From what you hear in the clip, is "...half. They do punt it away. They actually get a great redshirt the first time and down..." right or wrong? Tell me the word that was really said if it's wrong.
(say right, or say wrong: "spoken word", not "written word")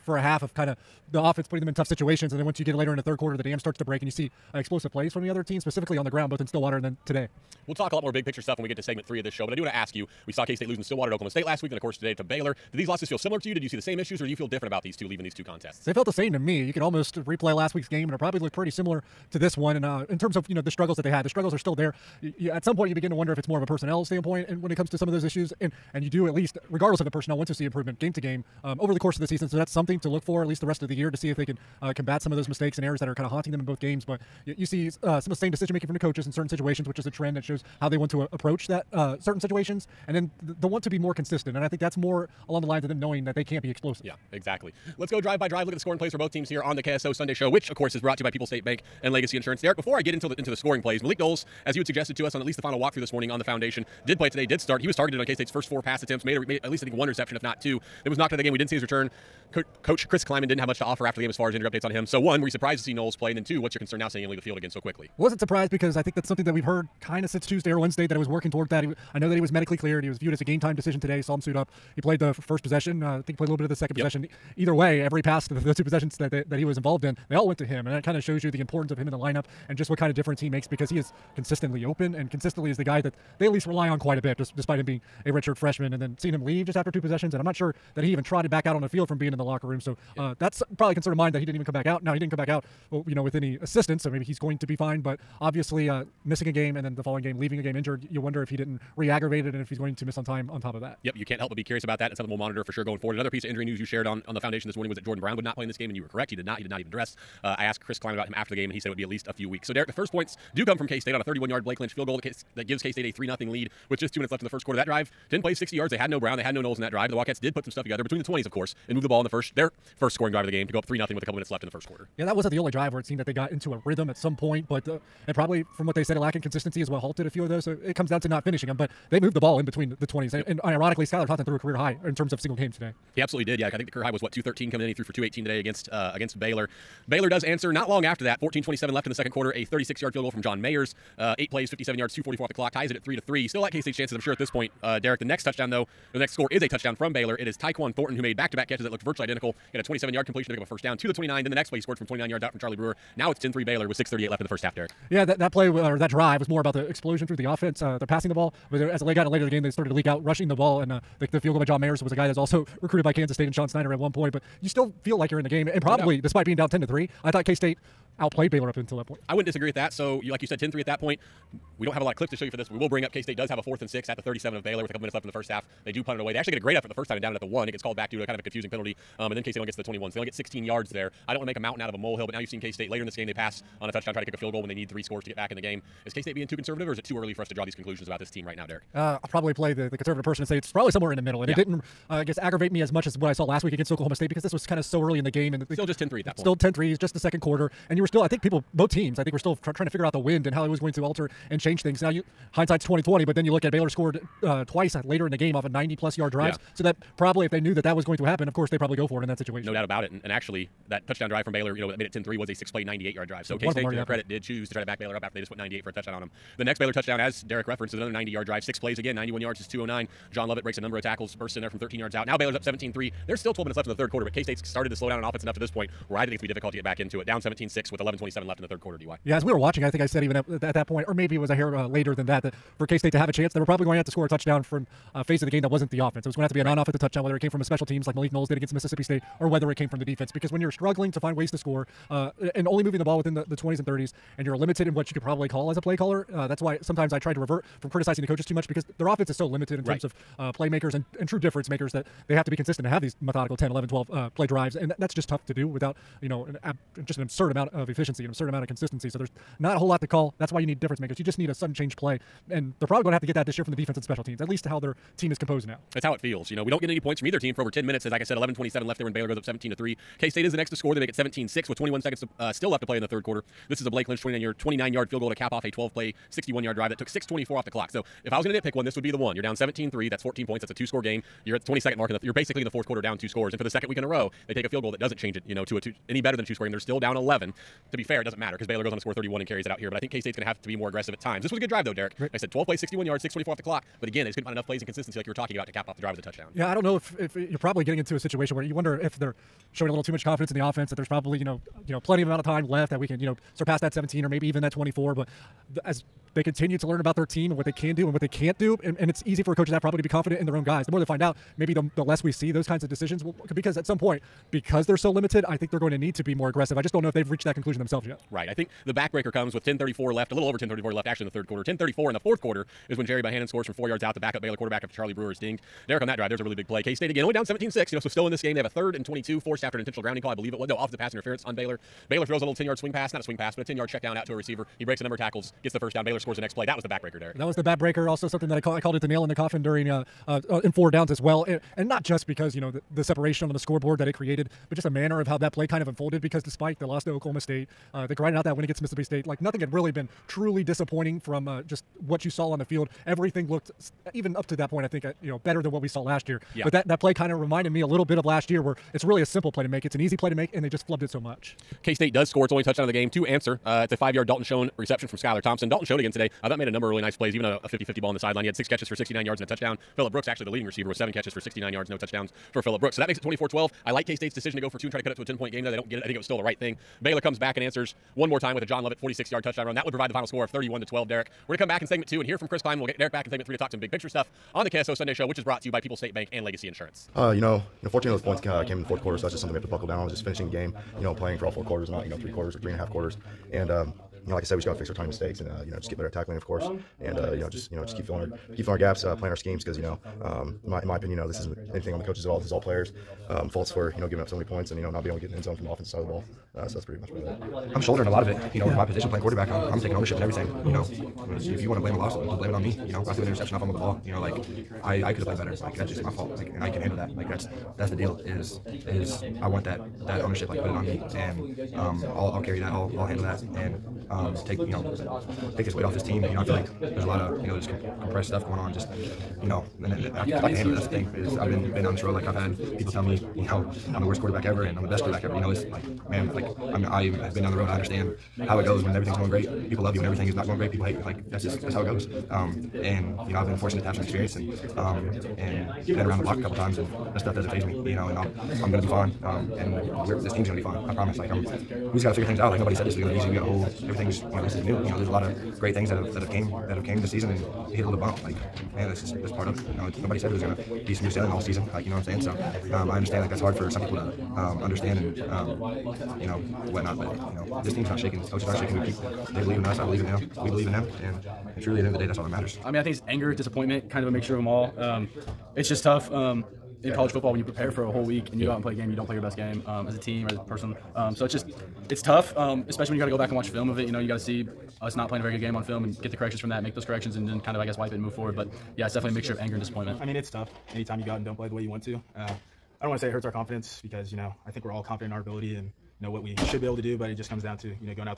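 wrong: "effort", not "redshirt".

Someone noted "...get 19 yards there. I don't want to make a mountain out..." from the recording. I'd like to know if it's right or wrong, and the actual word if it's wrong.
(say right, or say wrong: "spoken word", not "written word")
wrong: "16", not "19".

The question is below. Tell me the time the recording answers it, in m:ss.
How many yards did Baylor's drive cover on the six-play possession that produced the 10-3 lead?
3:32.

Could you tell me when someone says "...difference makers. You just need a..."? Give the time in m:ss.
4:20.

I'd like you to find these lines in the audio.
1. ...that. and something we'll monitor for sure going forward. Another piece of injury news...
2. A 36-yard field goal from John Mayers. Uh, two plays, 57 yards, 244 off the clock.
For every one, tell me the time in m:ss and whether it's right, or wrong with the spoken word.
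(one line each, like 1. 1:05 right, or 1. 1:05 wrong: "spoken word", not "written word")
1. 1:41 right
2. 2:19 wrong: "eight", not "two".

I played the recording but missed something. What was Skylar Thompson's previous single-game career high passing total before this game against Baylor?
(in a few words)
213.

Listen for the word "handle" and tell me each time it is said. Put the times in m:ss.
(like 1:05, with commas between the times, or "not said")
6:56, 7:03, 7:10.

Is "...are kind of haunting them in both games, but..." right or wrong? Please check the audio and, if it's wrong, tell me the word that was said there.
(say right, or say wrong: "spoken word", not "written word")
right.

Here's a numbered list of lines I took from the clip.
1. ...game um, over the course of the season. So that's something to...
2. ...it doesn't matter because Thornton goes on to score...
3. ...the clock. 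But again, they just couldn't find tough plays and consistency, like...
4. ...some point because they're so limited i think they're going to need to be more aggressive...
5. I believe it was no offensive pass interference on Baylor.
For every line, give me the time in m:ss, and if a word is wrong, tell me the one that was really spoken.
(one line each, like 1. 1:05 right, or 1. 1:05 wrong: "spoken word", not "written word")
1. 0:28 right
2. 4:48 wrong: "Baylor", not "Thornton"
3. 4:53 wrong: "enough", not "tough"
4. 5:13 right
5. 5:30 right.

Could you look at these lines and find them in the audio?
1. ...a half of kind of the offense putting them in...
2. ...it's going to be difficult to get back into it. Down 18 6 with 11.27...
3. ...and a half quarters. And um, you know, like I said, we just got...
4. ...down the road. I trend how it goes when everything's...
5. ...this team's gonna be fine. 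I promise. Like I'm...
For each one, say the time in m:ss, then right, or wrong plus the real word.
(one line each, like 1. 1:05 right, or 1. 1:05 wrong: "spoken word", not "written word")
1. 0:00 right
2. 3:46 wrong: "17", not "18"
3. 6:32 right
4. 7:17 wrong: "understand", not "trend"
5. 7:30 right.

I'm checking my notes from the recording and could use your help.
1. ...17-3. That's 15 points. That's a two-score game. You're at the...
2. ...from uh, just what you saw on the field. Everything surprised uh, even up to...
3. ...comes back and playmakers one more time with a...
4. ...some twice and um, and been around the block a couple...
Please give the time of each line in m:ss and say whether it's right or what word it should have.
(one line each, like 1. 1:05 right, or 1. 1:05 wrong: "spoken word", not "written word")
1. 4:39 wrong: "14", not "15"
2. 5:51 wrong: "looked", not "surprised"
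3. 6:17 wrong: "answers", not "playmakers"
4. 7:23 wrong: "experience", not "twice".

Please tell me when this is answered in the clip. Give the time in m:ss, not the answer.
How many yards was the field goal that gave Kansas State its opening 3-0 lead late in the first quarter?
1:51.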